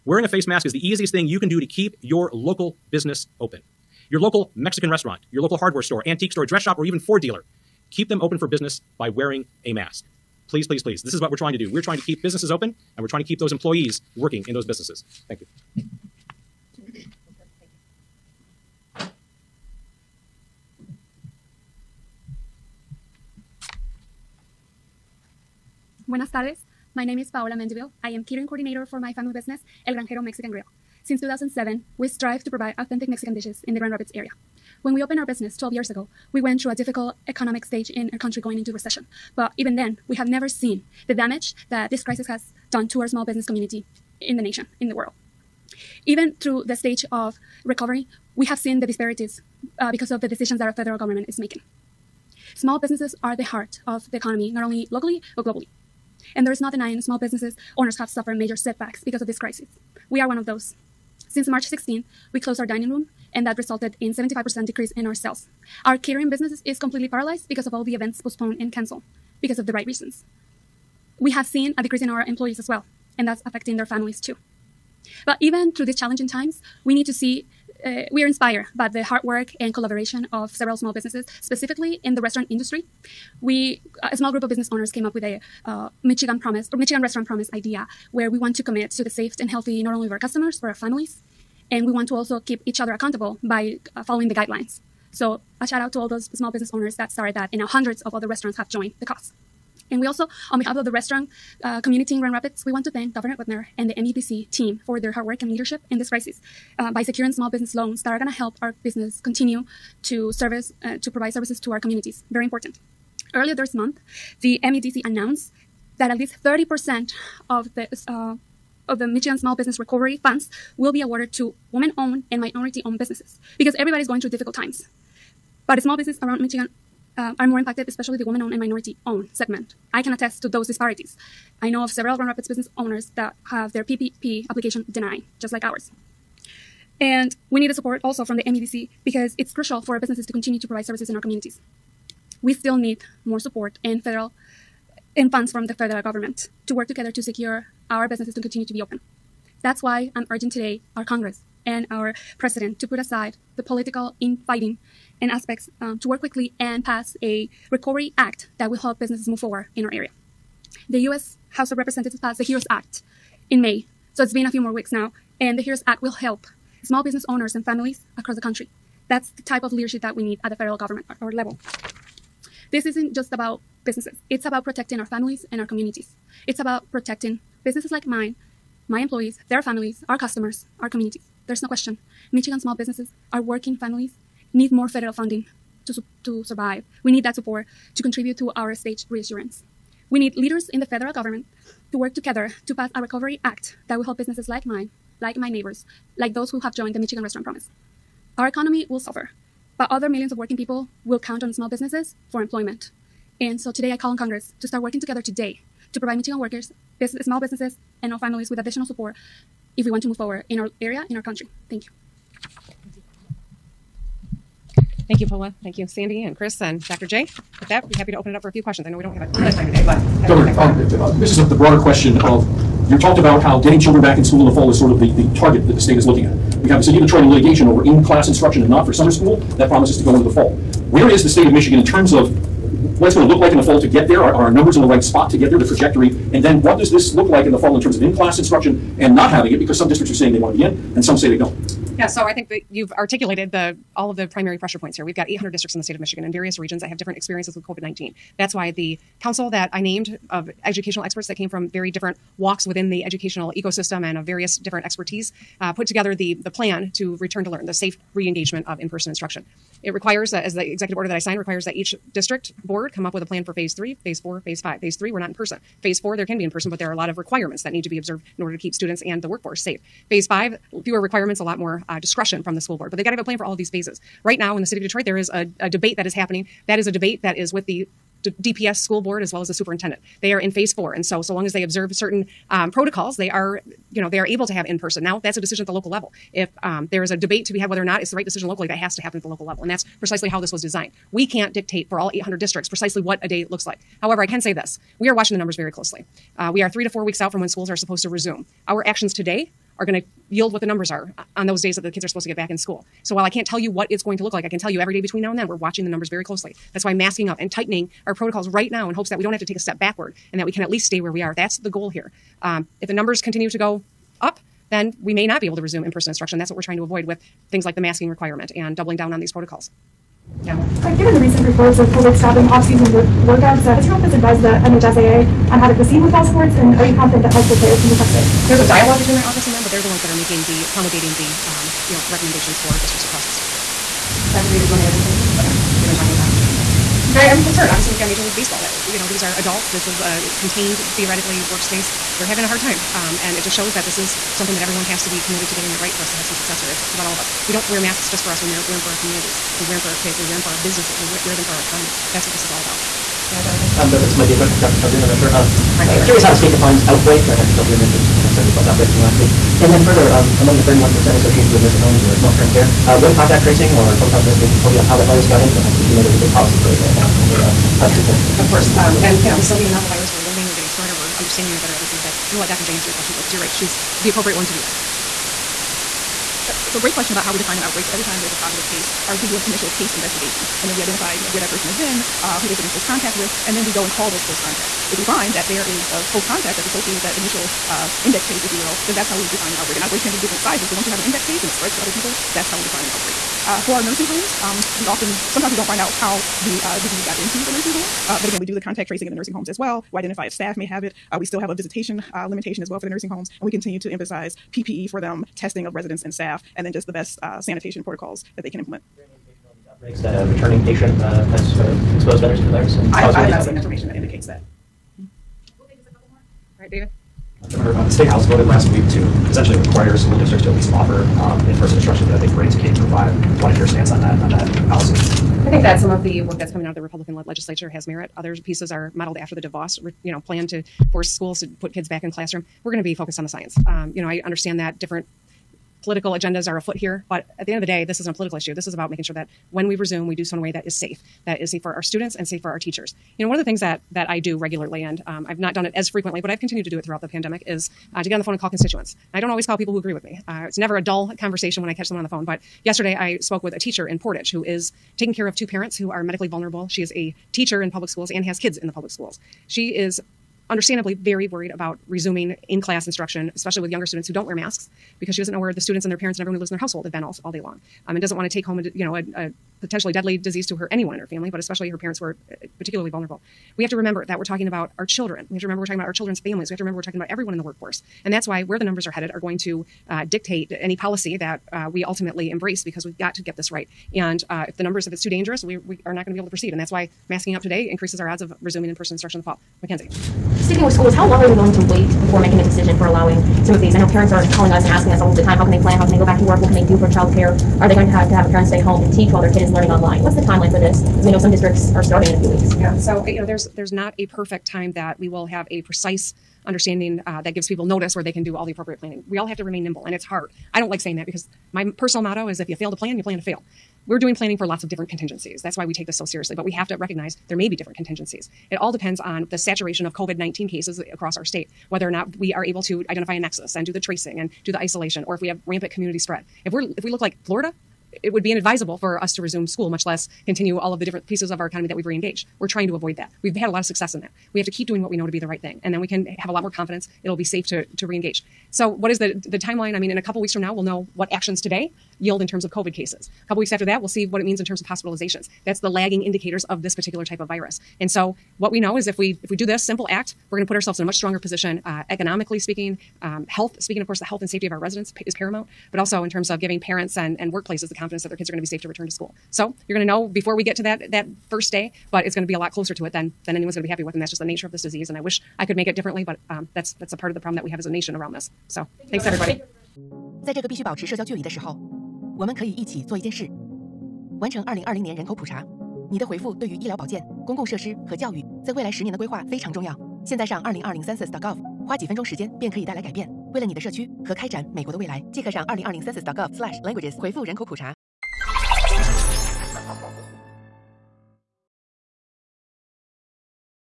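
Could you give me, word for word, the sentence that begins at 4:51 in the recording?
We can't dictate for all 800 districts precisely what a day looks like.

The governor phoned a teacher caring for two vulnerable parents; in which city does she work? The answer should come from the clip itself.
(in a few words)
Portage.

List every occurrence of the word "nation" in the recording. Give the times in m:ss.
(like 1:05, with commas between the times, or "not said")
0:44, 9:27.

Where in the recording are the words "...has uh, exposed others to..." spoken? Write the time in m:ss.
6:51.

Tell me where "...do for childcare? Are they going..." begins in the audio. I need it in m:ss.
8:16.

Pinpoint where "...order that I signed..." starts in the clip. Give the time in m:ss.
4:20.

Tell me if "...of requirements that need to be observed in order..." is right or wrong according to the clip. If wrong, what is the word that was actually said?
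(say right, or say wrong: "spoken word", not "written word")
right.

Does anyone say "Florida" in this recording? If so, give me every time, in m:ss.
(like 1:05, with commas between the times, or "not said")
8:47.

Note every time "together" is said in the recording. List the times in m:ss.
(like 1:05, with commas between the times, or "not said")
2:26, 3:12, 3:24, 4:15.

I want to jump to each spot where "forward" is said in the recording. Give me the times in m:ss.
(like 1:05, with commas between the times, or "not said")
2:39, 3:30.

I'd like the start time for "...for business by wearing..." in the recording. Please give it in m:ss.
0:08.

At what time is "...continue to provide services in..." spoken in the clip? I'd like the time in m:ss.
2:20.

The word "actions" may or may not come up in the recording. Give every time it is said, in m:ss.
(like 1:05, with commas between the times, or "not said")
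4:58, 9:01.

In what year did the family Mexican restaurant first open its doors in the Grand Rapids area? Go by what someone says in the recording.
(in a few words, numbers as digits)
2007.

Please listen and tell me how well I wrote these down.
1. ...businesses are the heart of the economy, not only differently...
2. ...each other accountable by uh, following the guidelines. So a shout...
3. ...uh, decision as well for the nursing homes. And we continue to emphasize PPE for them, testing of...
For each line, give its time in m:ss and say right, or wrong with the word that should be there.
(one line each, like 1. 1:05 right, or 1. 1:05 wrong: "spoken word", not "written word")
1. 0:52 wrong: "locally", not "differently"
2. 1:32 right
3. 6:42 wrong: "limitation", not "decision".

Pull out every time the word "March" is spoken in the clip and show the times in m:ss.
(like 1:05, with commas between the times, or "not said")
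1:01.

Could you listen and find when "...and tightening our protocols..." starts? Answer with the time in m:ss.
5:07.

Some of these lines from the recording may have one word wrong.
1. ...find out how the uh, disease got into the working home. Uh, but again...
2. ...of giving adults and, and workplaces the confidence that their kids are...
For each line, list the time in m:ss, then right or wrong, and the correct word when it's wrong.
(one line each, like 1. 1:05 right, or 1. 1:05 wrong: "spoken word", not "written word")
1. 6:35 wrong: "nursing", not "working"
2. 9:16 wrong: "parents", not "adults".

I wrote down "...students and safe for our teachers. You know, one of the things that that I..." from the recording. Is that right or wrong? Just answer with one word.
right.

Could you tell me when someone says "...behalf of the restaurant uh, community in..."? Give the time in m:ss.
1:40.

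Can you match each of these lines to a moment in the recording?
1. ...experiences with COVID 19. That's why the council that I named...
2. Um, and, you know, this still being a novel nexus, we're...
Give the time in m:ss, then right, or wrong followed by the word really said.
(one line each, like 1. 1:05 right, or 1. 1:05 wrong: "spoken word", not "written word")
1. 4:07 right
2. 6:08 wrong: "virus", not "nexus".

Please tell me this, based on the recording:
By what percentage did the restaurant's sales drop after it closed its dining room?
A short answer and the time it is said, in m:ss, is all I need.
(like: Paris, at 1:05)
75%, at 1:04.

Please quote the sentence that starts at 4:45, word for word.
Now, that's a decision at the local level.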